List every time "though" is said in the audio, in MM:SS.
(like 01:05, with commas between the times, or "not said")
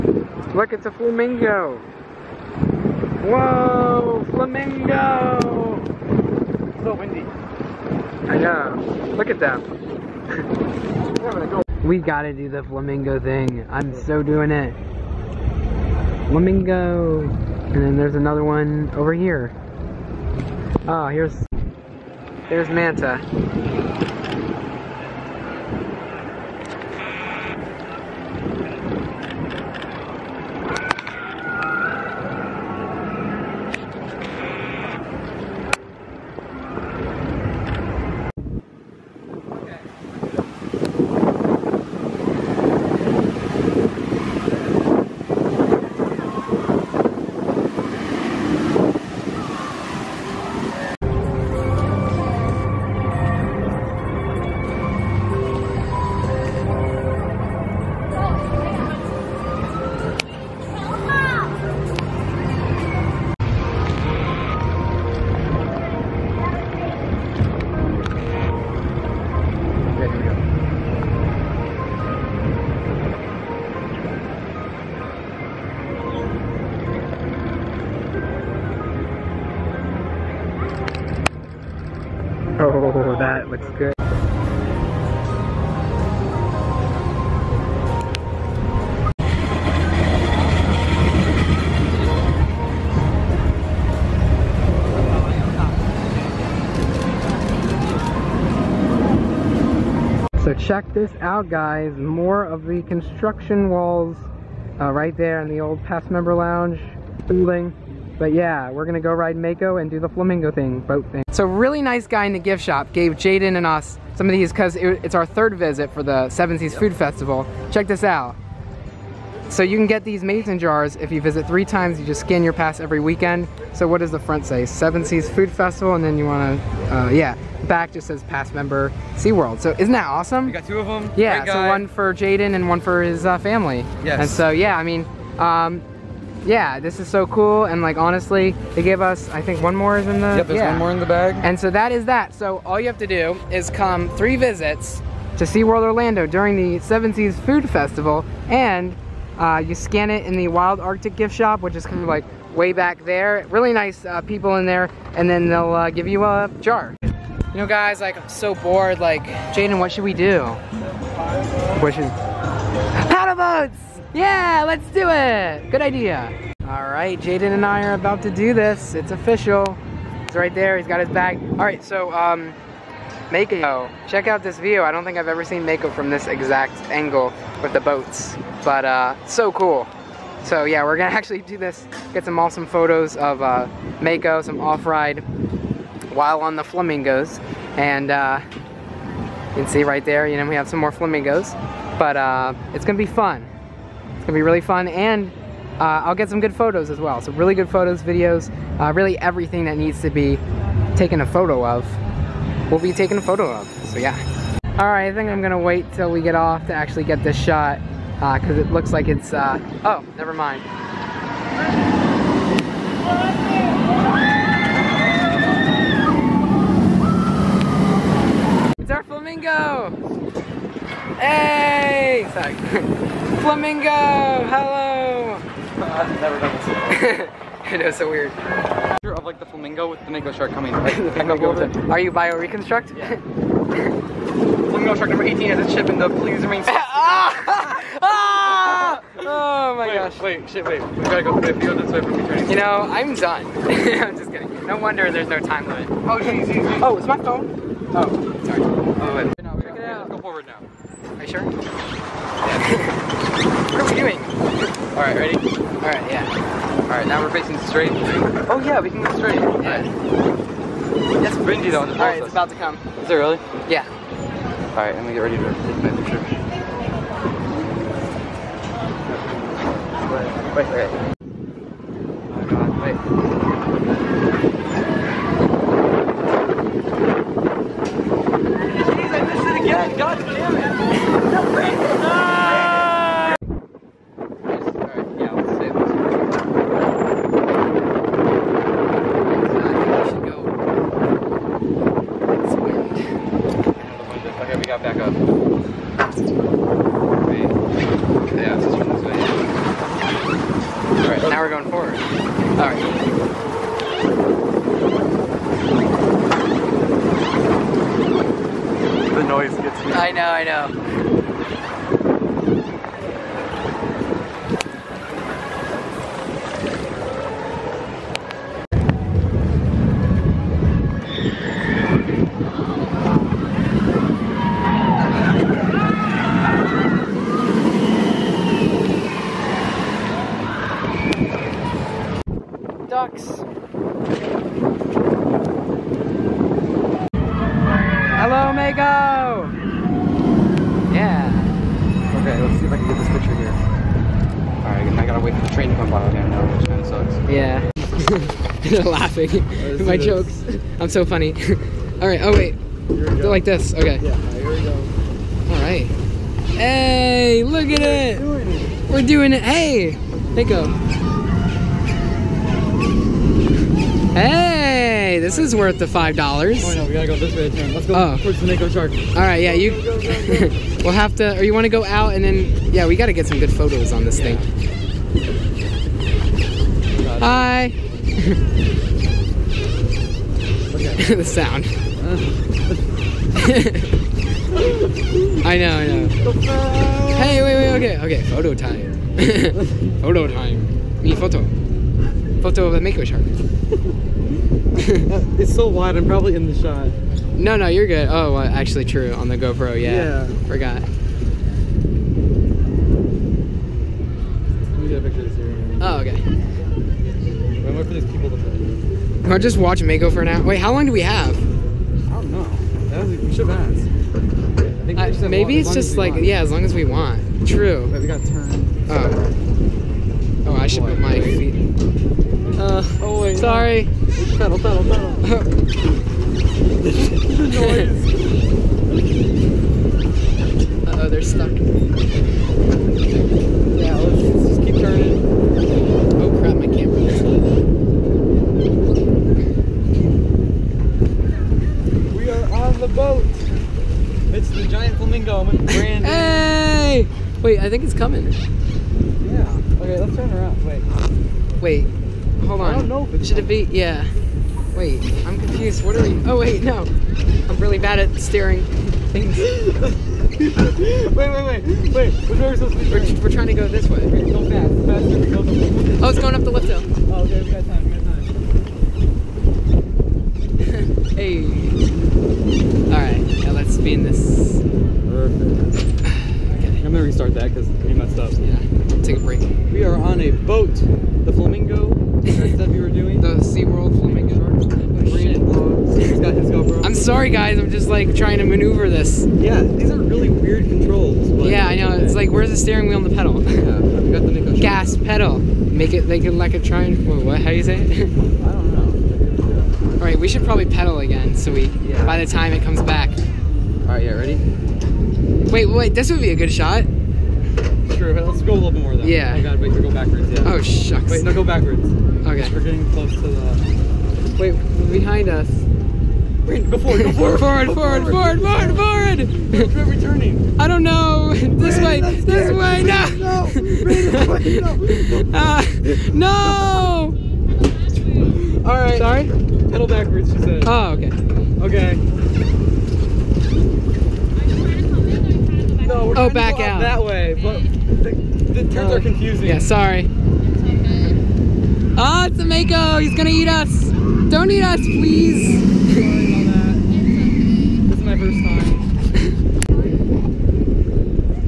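04:21, 08:28.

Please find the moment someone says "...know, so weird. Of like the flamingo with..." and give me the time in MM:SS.
03:47.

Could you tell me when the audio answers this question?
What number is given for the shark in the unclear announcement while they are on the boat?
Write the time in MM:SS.
03:55.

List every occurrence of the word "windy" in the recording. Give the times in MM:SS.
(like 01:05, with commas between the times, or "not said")
00:06, 04:21.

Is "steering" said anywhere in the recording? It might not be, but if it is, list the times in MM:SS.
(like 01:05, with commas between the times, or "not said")
07:38, 08:12.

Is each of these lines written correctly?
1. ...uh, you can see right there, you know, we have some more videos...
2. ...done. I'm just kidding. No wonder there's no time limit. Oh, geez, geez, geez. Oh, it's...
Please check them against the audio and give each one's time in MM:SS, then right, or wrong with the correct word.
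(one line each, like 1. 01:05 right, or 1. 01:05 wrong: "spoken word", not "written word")
1. 03:08 wrong: "flamingos", not "videos"
2. 04:03 right.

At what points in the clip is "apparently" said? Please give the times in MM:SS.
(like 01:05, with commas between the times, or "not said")
not said.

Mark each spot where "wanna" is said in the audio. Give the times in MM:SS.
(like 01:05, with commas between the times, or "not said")
02:06.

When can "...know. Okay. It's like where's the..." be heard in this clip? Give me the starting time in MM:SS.
08:11.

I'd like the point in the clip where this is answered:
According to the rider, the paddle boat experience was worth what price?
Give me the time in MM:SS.
06:05.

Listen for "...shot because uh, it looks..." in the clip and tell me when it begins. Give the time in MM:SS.
03:27.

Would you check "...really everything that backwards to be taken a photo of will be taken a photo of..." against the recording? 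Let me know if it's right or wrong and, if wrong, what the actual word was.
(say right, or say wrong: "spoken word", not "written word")
wrong: "needs", not "backwards".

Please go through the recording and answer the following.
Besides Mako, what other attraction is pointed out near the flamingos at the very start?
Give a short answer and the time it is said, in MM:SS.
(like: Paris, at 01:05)
Manta, at 00:22.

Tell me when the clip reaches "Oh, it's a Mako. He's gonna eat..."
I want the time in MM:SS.
09:02.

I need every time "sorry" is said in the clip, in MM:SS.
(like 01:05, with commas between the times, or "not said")
03:42, 04:08, 07:03, 08:06, 08:48, 08:59, 09:05.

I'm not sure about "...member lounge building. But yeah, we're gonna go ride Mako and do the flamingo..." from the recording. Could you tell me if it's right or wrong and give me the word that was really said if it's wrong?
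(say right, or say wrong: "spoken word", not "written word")
right.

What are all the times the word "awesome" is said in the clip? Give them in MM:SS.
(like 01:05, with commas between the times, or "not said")
02:10, 03:02.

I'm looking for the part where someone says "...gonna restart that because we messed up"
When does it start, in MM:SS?
07:56.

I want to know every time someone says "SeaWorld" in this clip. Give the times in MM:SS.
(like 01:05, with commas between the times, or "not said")
02:09, 02:25, 08:03.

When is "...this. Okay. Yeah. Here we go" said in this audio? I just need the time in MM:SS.
05:53.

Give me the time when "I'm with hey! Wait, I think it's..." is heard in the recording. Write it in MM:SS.
07:25.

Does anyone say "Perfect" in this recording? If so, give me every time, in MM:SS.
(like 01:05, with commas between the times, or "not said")
07:55.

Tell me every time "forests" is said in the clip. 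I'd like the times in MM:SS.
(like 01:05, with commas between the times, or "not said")
not said.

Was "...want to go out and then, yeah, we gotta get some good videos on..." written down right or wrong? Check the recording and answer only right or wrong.
wrong.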